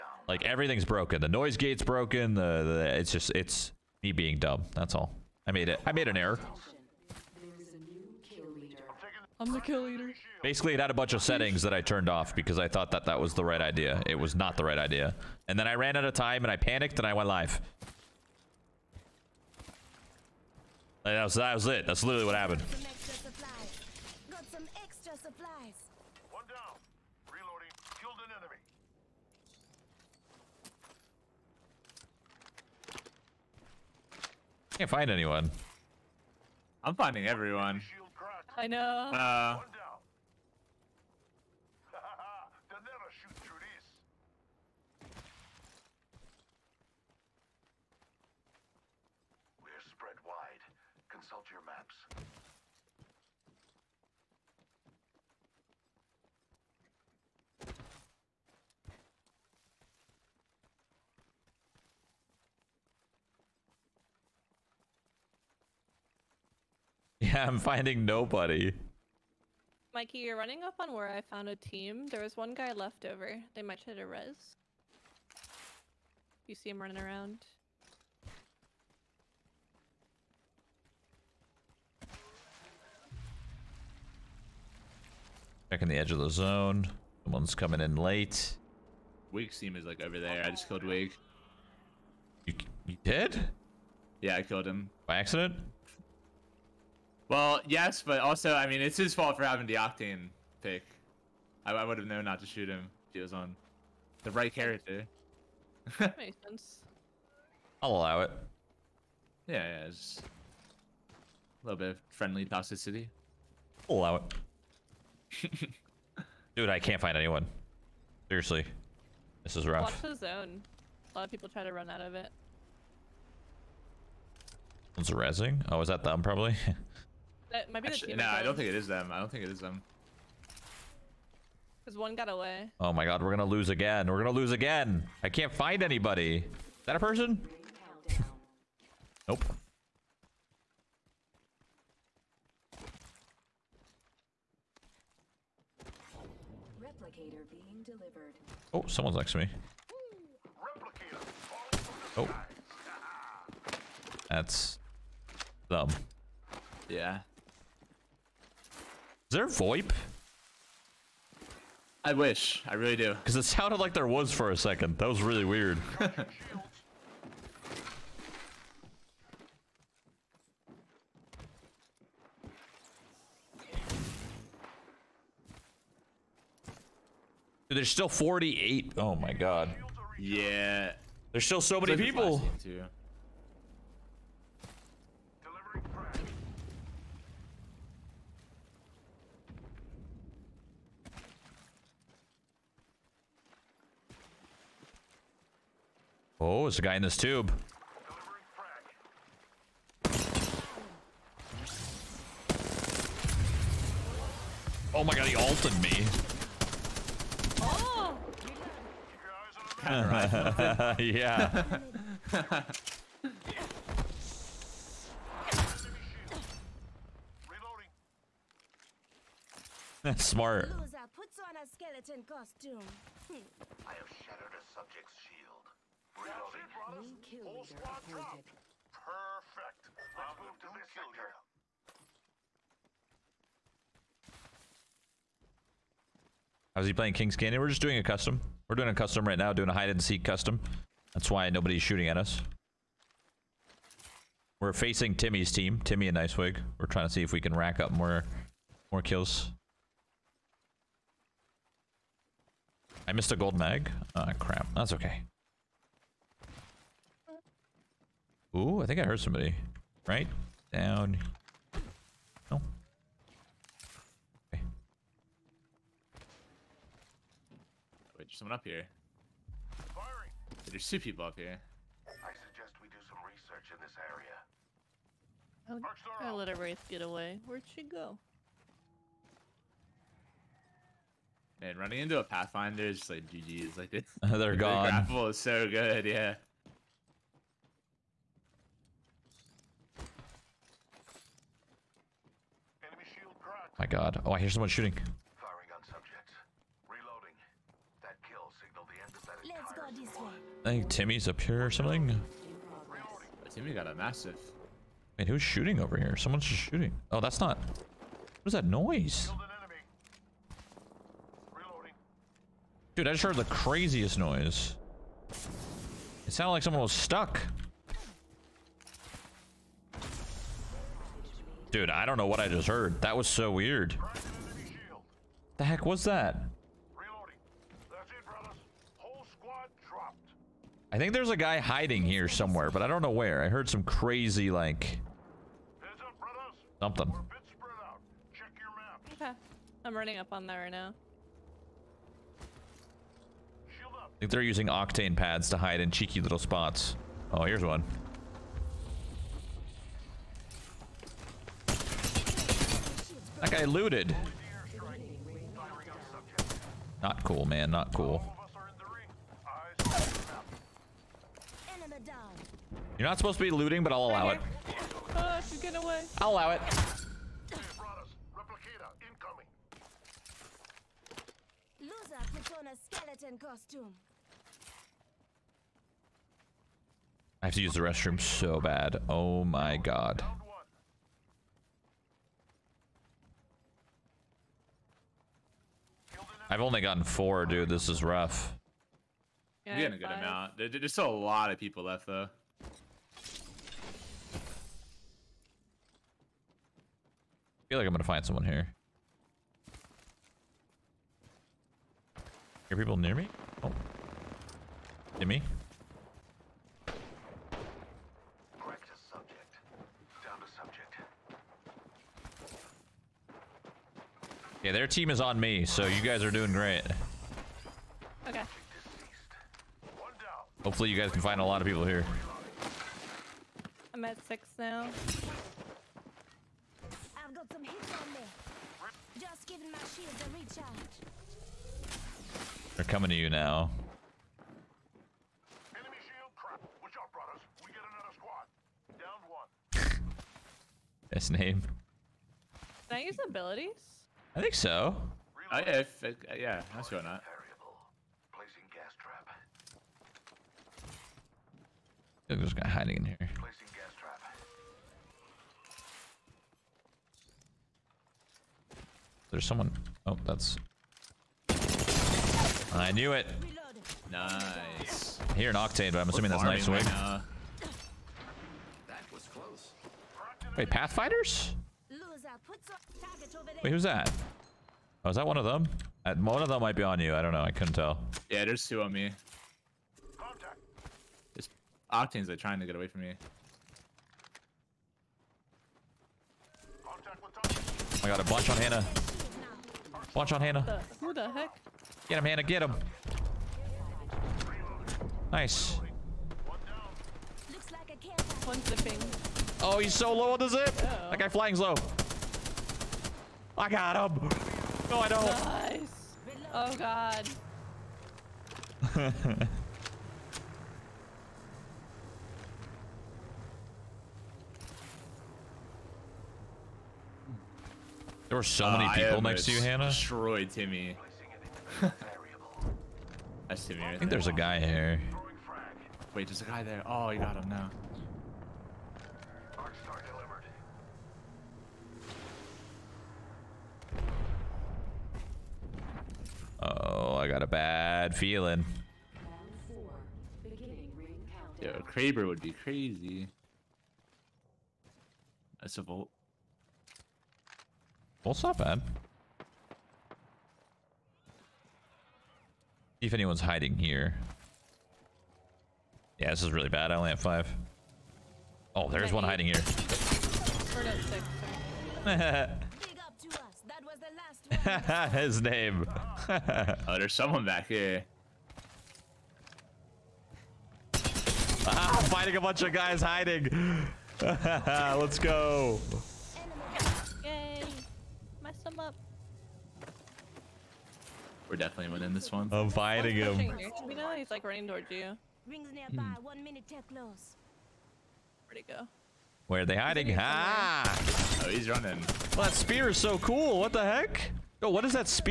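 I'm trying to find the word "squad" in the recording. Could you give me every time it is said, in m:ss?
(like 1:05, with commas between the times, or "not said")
3:47, 7:18.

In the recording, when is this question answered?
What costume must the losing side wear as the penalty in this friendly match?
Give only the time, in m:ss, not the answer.
3:41.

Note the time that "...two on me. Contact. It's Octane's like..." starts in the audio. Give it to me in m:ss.
7:58.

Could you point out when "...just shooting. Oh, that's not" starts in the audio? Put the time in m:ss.
5:06.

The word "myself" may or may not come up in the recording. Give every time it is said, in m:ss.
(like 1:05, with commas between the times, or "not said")
not said.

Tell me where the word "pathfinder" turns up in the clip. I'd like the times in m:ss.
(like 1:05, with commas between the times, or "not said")
4:42, 7:50.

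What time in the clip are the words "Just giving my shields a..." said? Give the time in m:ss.
7:09.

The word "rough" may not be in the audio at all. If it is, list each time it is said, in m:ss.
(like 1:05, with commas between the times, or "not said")
1:59, 6:28.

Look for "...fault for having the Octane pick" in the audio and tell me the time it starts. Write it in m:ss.
1:39.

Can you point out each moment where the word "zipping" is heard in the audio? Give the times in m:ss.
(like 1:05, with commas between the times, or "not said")
8:18.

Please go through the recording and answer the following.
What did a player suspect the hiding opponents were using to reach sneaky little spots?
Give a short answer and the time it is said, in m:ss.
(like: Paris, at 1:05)
octane pads, at 5:44.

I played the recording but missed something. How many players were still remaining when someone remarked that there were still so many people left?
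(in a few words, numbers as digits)
48.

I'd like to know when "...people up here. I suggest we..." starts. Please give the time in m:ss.
4:30.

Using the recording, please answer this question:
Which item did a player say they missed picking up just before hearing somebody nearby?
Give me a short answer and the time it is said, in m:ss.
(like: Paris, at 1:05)
gold mag, at 4:13.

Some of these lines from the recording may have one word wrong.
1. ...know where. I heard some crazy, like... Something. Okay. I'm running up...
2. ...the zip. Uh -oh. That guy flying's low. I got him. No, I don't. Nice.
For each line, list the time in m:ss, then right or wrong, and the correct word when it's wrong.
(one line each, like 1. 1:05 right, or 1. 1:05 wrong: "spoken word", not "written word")
1. 5:33 right
2. 8:20 right.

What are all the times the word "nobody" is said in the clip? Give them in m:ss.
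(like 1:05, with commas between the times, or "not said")
1:08, 4:01.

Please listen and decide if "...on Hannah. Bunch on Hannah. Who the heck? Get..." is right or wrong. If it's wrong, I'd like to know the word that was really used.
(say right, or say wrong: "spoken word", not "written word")
right.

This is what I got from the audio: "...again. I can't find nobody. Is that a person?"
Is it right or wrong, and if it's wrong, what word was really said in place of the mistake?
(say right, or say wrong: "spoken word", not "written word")
wrong: "anybody", not "nobody".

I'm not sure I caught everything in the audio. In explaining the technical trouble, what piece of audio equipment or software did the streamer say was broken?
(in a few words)
noise gate.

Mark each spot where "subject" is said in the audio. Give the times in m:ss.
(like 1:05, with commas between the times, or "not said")
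3:44, 4:55.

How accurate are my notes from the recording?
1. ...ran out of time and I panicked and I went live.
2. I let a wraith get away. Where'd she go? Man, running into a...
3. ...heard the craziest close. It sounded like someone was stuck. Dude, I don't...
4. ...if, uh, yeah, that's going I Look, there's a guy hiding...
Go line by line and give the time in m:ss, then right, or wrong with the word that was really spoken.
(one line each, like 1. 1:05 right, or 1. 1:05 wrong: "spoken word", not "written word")
1. 0:15 right
2. 4:36 right
3. 5:13 wrong: "noise", not "close"
4. 7:25 right.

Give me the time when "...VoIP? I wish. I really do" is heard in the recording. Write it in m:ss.
2:39.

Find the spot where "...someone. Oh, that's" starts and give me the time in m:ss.
7:39.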